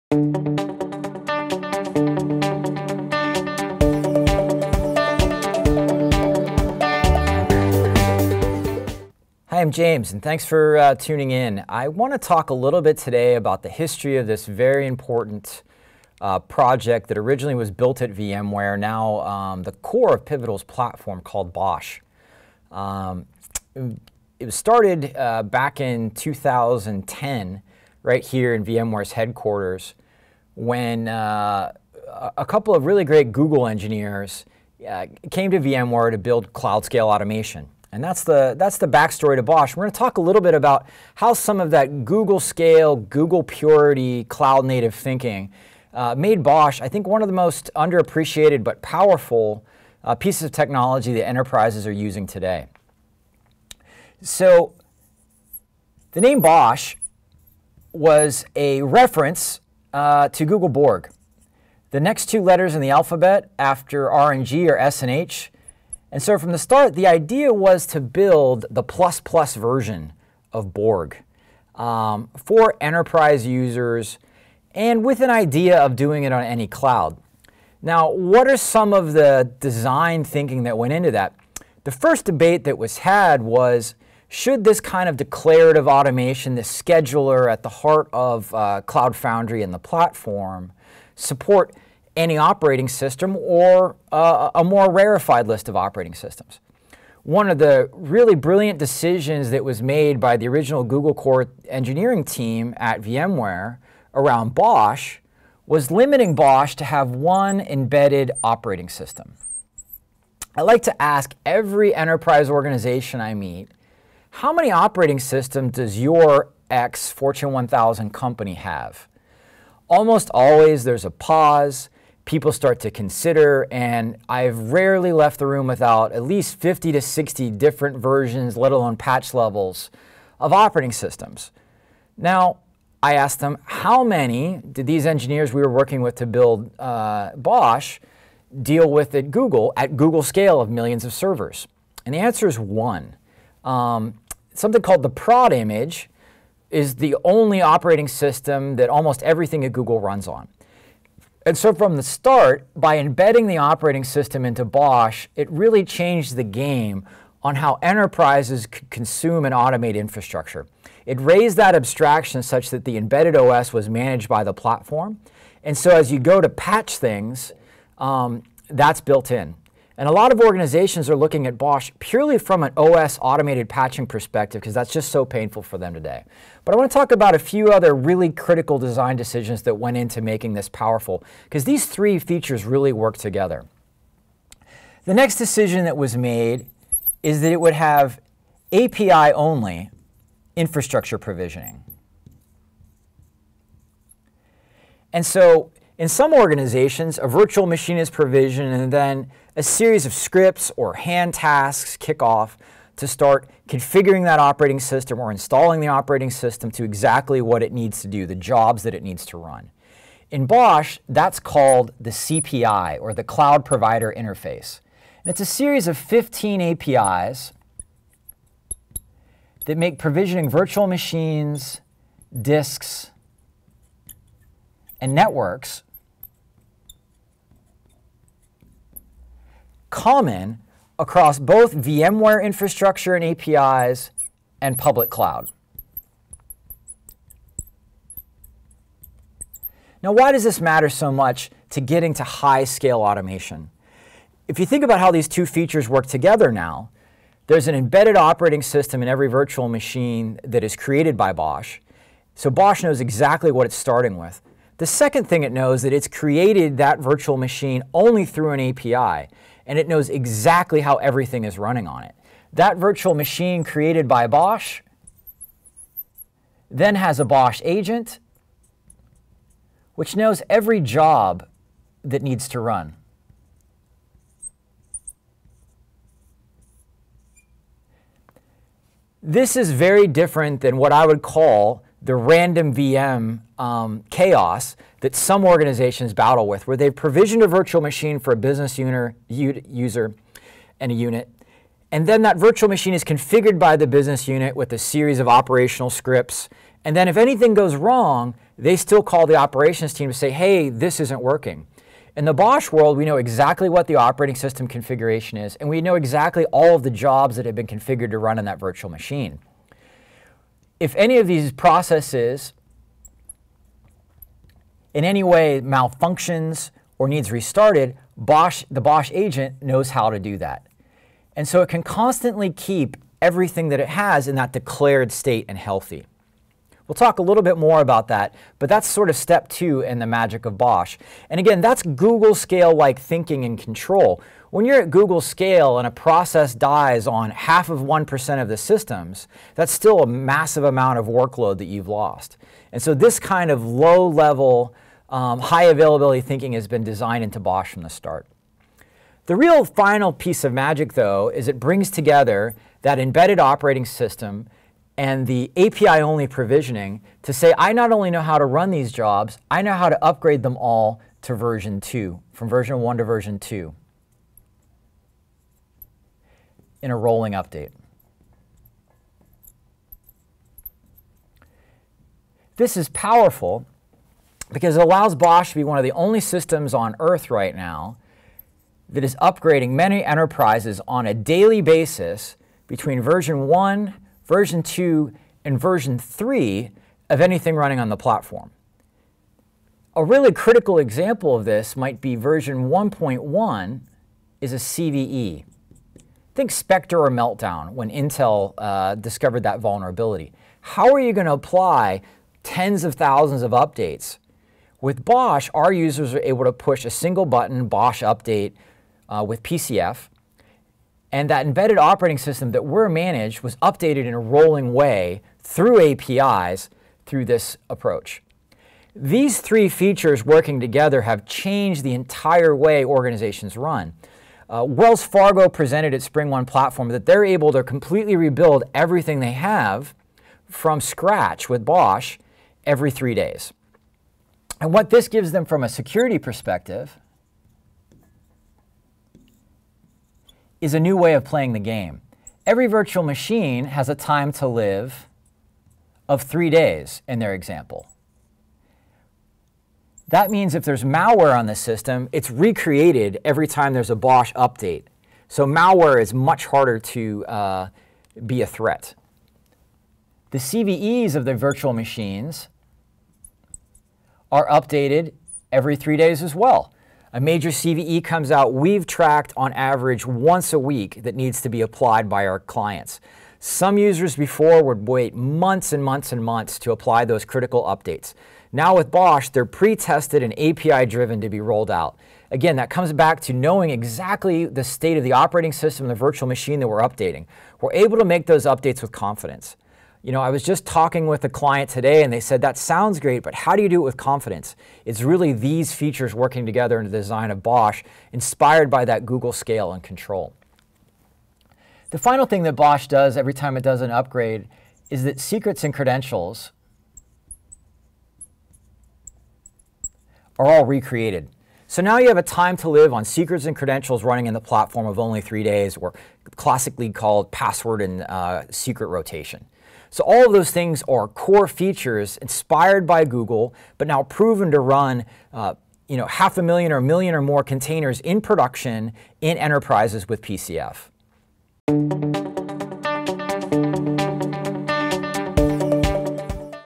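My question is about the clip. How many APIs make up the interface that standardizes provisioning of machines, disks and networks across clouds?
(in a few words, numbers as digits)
15.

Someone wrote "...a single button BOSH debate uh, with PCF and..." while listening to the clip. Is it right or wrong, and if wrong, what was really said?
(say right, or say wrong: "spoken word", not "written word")
wrong: "update", not "debate".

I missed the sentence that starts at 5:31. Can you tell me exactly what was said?
And again, that's Google scale like thinking and control.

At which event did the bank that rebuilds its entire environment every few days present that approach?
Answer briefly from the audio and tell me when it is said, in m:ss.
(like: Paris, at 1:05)
SpringOne Platform, at 7:06.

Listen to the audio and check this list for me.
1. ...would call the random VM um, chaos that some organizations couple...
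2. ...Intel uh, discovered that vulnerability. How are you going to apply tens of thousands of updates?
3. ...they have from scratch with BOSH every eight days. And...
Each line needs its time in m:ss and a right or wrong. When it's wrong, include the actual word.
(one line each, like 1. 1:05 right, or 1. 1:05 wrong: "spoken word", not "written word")
1. 4:41 wrong: "battle", not "couple"
2. 6:37 right
3. 7:09 wrong: "three", not "eight".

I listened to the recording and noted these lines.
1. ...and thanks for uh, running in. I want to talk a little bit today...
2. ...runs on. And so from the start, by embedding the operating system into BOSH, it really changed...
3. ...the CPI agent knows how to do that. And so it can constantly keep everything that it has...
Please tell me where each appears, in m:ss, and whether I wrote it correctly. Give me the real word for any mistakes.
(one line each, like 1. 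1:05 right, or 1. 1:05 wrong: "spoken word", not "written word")
1. 0:10 wrong: "tuning", not "running"
2. 2:29 right
3. 5:18 wrong: "BOSH", not "CPI".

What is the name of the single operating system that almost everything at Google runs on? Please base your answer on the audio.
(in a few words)
prod image.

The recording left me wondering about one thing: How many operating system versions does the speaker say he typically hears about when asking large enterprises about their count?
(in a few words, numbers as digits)
50 to 60.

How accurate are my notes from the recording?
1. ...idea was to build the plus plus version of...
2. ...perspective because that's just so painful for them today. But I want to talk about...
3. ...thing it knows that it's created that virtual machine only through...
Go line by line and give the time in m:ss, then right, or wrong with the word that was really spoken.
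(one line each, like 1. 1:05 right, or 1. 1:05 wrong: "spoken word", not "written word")
1. 1:07 right
2. 2:54 right
3. 4:15 right.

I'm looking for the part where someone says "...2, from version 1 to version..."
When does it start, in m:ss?
6:01.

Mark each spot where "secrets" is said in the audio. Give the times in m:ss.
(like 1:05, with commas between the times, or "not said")
8:25, 8:33, 8:38.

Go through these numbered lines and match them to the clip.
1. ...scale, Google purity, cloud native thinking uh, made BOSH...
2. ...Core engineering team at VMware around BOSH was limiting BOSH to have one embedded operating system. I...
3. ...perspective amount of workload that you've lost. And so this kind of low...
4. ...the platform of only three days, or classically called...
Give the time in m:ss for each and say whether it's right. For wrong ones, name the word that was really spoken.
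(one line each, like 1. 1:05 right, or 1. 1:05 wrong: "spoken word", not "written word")
1. 0:42 right
2. 1:41 right
3. 5:40 wrong: "massive", not "perspective"
4. 8:34 right.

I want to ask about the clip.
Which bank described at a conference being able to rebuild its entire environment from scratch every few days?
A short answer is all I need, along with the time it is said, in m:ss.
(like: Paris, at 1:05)
Wells Fargo, at 7:04.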